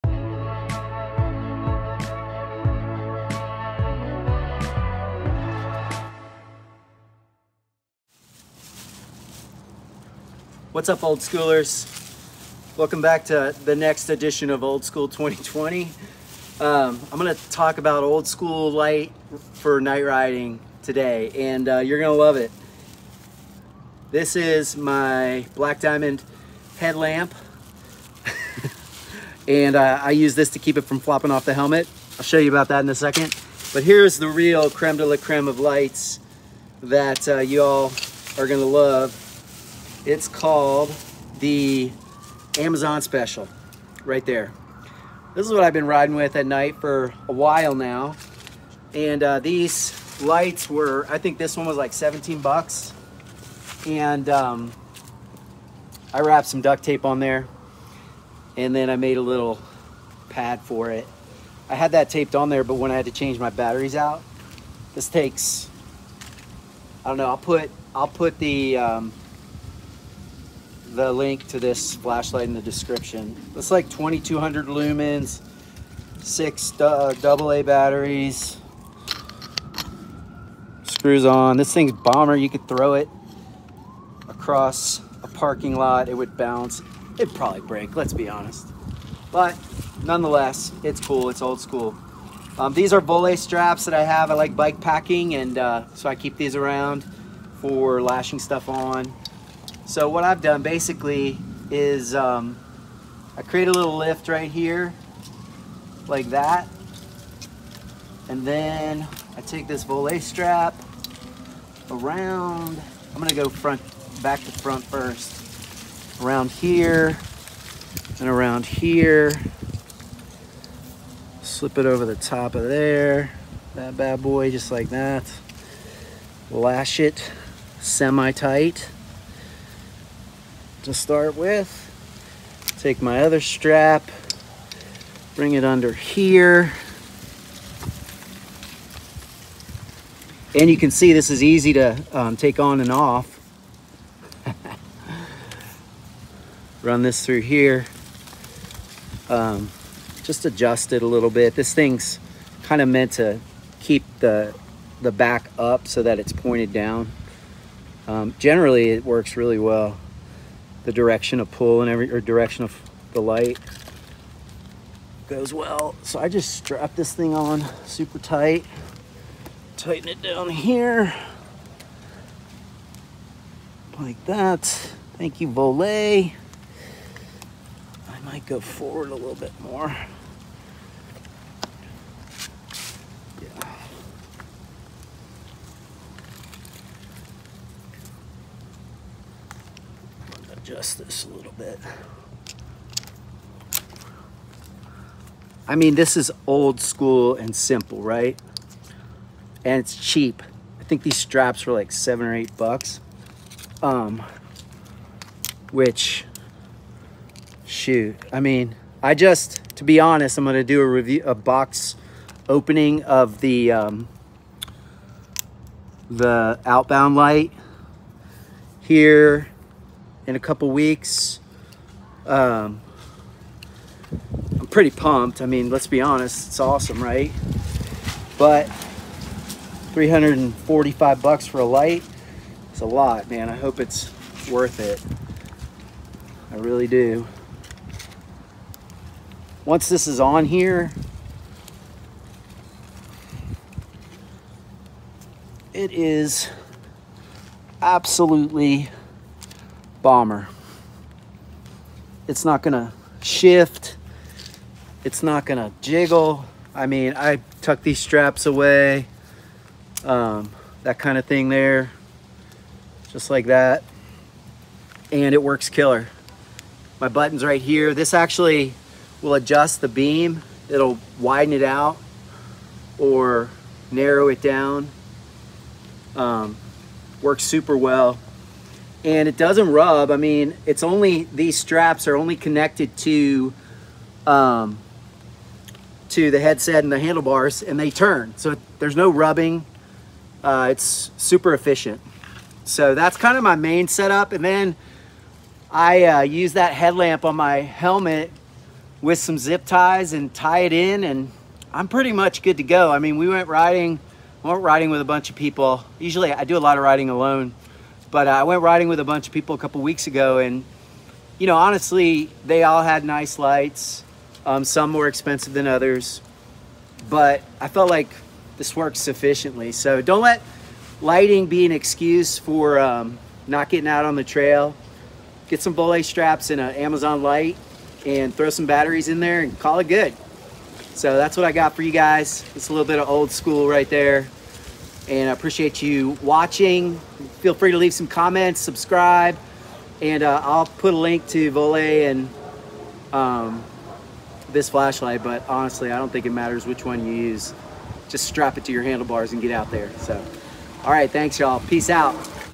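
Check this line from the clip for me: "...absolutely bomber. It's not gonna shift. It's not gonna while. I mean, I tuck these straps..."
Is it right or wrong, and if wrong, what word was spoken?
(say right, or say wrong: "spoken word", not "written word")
wrong: "jiggle", not "while".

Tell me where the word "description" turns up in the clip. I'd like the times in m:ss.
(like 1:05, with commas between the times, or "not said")
1:12.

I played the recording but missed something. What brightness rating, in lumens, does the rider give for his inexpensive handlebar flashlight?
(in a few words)
2200.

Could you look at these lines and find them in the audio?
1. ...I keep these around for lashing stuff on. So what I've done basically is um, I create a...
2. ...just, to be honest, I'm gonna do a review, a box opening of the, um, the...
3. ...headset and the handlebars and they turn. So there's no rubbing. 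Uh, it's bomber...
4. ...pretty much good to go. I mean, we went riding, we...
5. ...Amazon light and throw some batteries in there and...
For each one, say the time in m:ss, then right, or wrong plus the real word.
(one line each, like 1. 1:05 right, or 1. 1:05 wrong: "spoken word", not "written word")
1. 1:36 right
2. 3:29 right
3. 4:46 wrong: "super", not "bomber"
4. 5:01 right
5. 5:26 right.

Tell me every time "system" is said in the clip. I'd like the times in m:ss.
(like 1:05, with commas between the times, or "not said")
not said.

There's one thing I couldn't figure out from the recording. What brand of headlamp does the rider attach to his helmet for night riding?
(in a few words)
Black Diamond.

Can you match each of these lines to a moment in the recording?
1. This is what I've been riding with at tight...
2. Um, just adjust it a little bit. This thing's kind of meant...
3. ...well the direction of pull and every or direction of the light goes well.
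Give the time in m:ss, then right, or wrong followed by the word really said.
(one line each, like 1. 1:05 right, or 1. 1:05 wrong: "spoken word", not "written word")
1. 0:45 wrong: "night", not "tight"
2. 2:29 right
3. 2:39 right.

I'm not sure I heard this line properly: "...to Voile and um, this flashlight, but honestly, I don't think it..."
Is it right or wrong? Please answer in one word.
right.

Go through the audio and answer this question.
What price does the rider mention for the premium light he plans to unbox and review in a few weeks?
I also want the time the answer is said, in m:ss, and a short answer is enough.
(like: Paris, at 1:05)
$345, at 3:49.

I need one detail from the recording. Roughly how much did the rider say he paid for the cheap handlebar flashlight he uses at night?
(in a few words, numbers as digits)
$17.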